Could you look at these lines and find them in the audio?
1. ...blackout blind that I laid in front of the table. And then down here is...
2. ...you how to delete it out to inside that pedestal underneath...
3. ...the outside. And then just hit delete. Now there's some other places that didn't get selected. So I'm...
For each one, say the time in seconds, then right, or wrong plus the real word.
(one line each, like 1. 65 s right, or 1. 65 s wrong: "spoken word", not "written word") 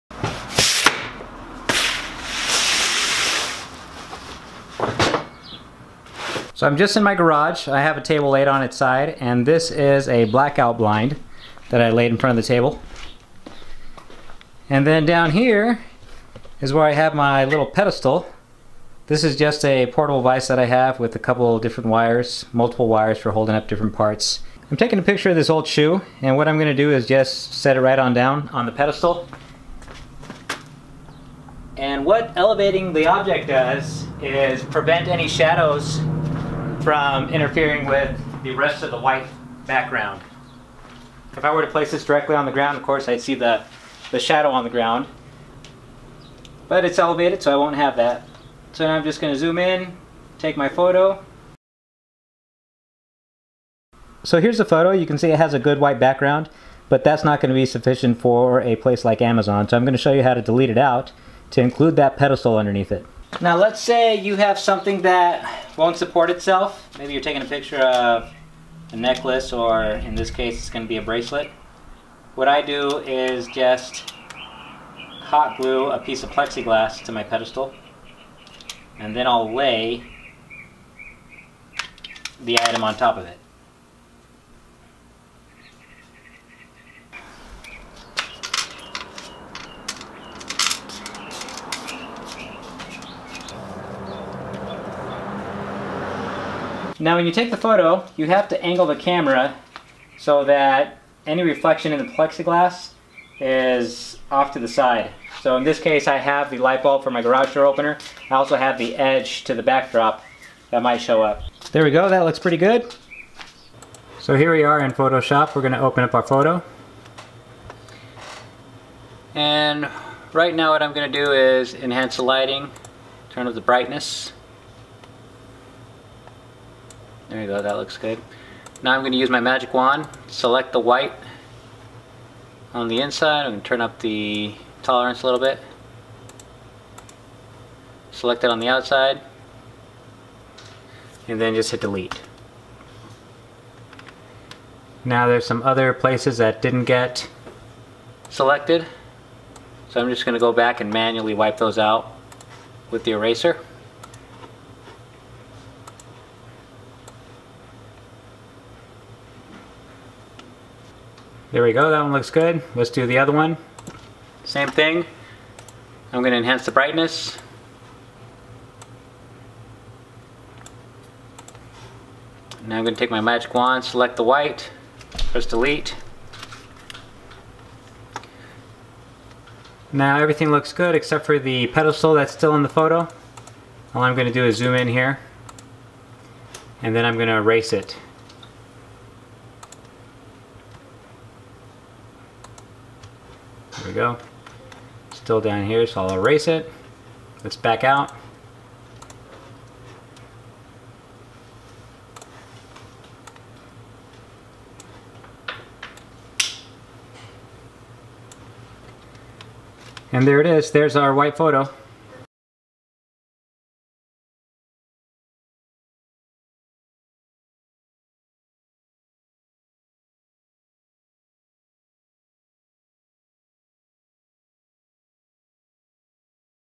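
1. 10 s right
2. 60 s wrong: "include", not "inside"
3. 138 s right.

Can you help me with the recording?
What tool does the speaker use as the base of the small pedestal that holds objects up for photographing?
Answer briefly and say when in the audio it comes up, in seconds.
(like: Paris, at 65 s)
portable vise, at 19 s.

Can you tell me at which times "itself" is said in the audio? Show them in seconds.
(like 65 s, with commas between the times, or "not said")
66 s.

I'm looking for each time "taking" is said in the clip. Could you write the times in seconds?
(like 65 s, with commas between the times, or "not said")
24 s, 67 s.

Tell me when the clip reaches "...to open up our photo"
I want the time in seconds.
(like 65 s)
115 s.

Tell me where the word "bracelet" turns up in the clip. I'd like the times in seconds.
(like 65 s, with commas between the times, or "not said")
71 s.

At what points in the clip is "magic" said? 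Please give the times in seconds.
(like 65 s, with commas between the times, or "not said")
129 s, 173 s.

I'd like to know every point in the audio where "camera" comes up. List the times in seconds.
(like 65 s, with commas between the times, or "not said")
98 s.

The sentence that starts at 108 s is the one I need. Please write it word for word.
I also have the edge to the backdrop that might show up.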